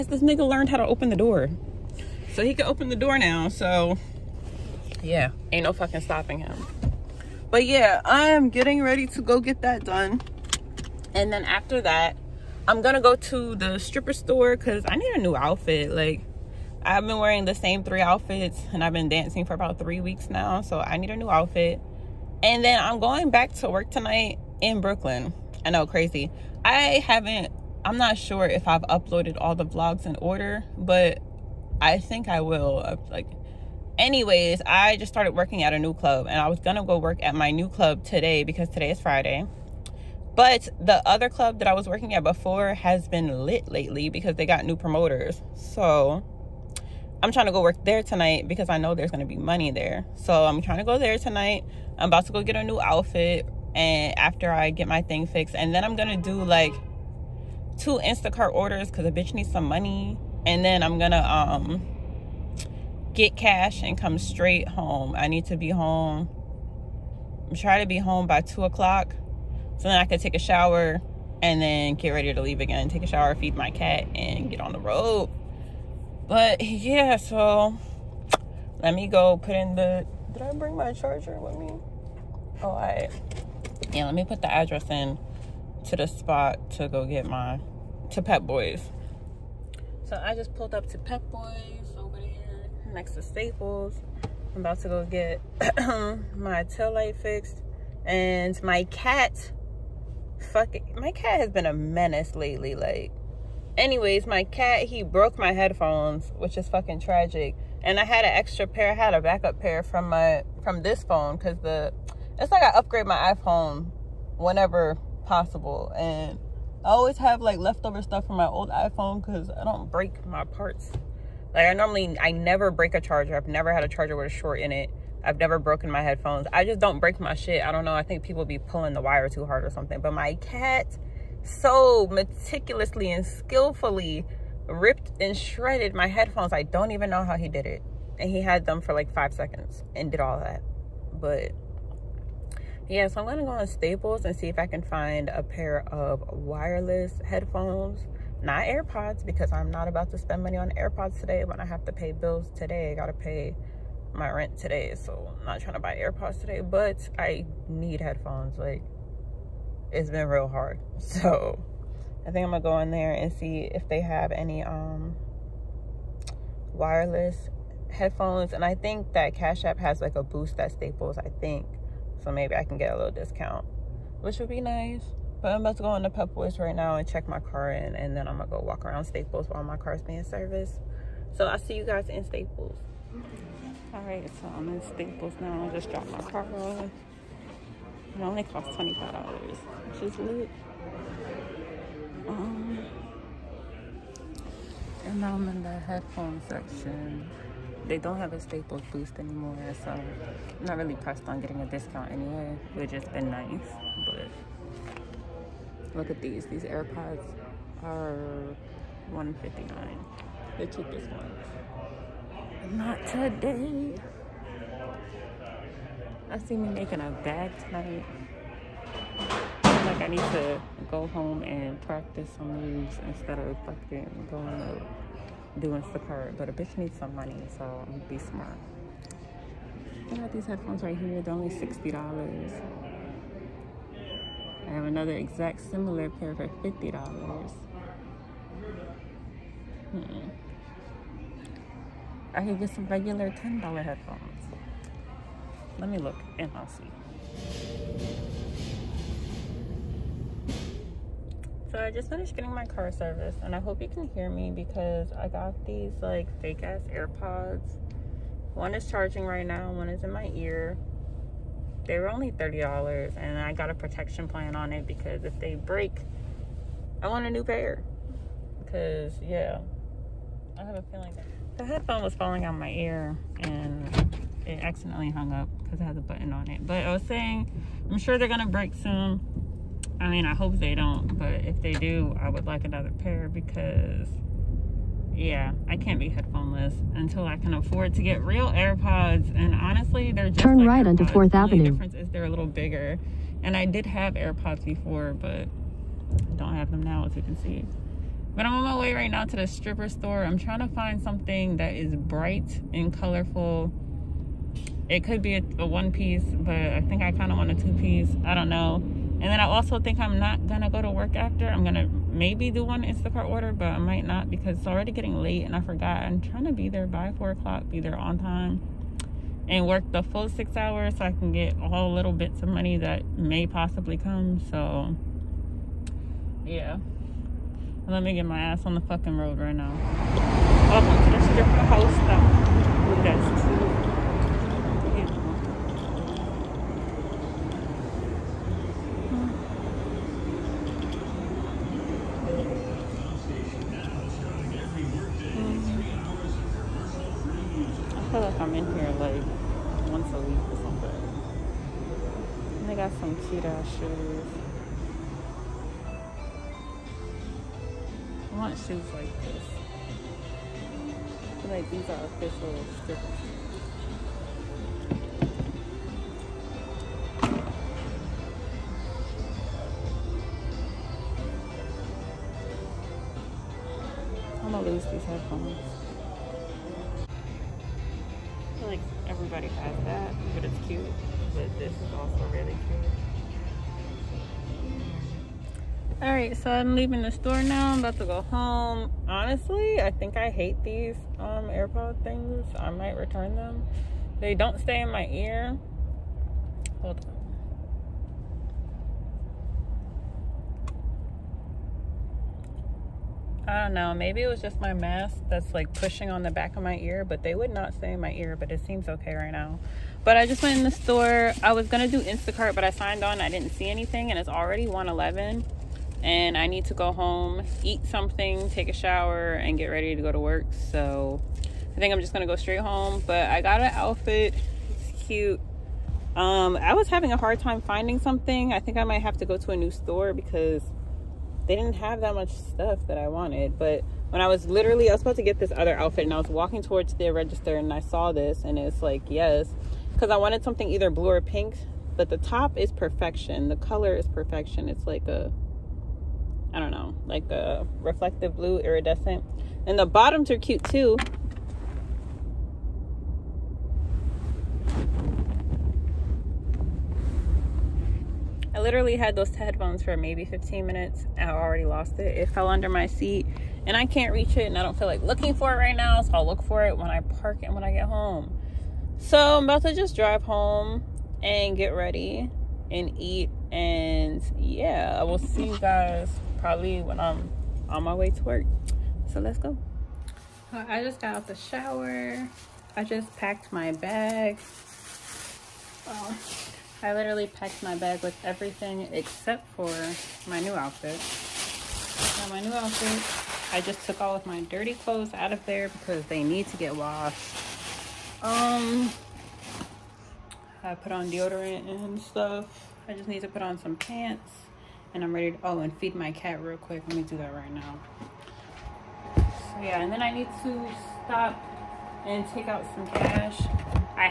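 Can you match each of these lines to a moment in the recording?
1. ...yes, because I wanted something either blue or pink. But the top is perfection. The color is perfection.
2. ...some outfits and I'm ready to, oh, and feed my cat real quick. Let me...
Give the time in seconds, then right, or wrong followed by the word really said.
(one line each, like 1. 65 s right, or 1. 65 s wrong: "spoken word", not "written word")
1. 439 s right
2. 503 s wrong: "pants", not "outfits".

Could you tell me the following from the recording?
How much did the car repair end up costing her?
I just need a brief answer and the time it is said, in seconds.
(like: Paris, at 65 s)
$25, at 188 s.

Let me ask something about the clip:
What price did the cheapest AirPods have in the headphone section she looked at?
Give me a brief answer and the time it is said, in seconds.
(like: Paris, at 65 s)
159, at 209 s.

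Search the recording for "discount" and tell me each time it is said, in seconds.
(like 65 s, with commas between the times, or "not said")
173 s, 201 s.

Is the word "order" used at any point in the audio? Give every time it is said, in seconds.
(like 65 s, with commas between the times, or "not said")
30 s, 58 s, 313 s.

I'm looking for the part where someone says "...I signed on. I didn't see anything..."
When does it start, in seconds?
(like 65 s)
412 s.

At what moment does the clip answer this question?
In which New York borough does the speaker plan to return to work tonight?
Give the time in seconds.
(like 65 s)
24 s.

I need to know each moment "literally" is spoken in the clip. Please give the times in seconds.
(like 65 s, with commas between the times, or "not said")
434 s, 458 s, 486 s.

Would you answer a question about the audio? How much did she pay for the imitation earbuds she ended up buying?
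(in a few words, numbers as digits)
$30.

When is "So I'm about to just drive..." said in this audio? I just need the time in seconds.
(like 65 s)
468 s.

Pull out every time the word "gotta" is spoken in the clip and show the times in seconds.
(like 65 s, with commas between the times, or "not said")
152 s.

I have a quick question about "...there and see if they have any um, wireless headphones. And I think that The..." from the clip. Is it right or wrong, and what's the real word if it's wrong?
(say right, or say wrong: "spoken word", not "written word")
wrong: "Cash", not "The".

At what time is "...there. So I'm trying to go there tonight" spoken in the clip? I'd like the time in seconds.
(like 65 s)
49 s.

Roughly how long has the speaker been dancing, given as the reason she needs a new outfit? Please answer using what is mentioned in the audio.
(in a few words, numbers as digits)
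3 weeks.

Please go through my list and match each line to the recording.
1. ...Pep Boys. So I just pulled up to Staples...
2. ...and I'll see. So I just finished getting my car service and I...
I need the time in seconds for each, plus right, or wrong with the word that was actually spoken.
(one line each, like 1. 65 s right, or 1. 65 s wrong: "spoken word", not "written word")
1. 88 s wrong: "Pep", not "Staples"
2. 246 s right.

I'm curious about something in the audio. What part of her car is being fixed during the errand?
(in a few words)
Tail light.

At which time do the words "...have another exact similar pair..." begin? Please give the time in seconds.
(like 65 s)
234 s.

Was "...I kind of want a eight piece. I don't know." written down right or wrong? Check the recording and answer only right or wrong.
wrong.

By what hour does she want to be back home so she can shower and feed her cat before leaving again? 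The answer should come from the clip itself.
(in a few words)
2 o'clock.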